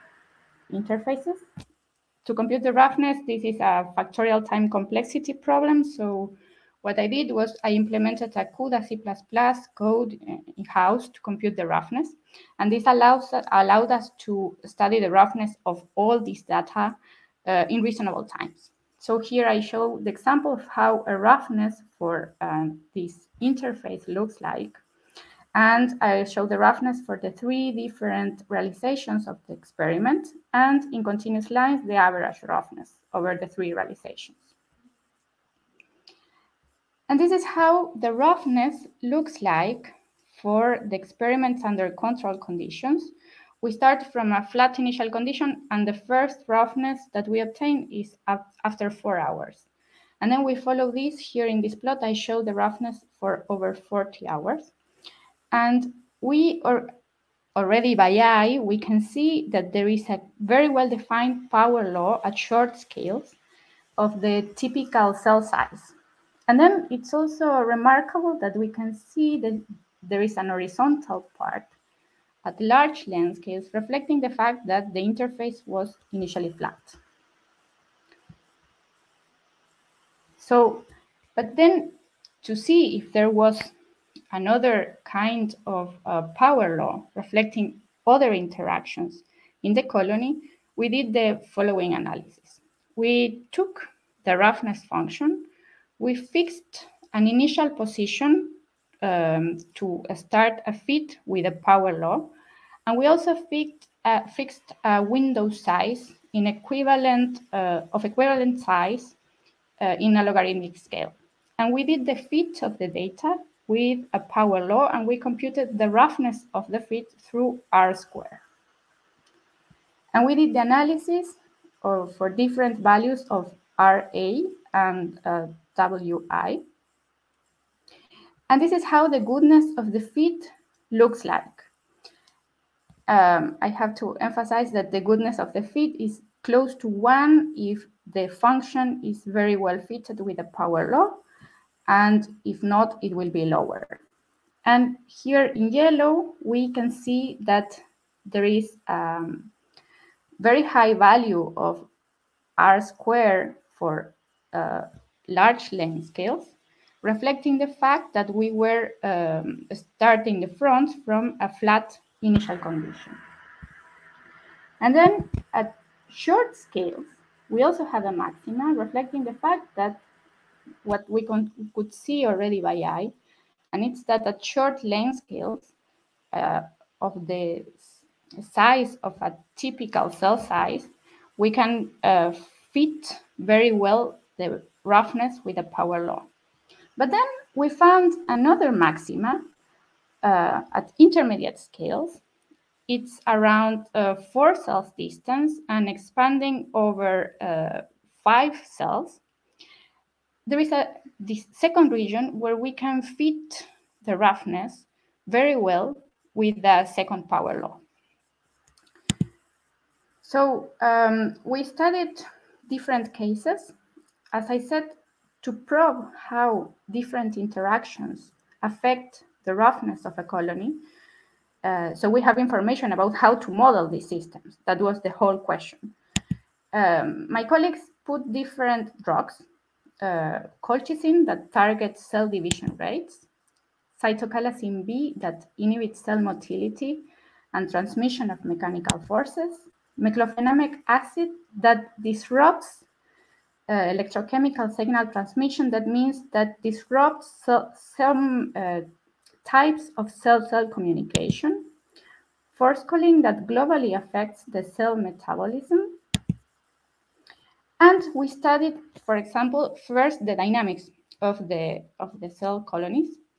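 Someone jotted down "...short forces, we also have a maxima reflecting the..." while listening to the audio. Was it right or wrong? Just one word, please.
wrong.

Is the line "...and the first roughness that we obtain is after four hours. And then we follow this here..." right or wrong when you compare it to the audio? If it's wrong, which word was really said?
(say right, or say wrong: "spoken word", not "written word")
right.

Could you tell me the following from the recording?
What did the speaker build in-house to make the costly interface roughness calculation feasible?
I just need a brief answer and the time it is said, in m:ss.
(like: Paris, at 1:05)
CUDA C++, at 0:08.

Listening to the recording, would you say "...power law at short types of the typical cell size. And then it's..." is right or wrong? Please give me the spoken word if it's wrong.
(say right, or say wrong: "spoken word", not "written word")
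wrong: "scales", not "types".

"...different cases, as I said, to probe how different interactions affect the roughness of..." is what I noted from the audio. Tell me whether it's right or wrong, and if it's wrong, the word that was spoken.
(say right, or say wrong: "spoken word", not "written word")
right.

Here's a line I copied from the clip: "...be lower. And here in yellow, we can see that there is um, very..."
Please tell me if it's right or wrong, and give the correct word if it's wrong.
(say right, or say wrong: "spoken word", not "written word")
right.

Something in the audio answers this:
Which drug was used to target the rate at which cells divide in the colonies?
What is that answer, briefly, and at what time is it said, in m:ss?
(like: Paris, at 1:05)
colchicine, at 3:50.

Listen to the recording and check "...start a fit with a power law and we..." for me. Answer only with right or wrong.
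right.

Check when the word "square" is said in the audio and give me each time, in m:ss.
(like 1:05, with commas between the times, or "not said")
1:57, 2:32.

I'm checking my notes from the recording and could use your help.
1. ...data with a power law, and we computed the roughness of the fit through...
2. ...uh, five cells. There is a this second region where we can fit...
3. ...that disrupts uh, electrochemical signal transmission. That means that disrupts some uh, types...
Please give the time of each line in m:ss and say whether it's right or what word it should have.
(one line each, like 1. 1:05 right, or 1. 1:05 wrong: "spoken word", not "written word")
1. 1:52 right
2. 3:17 right
3. 4:01 right.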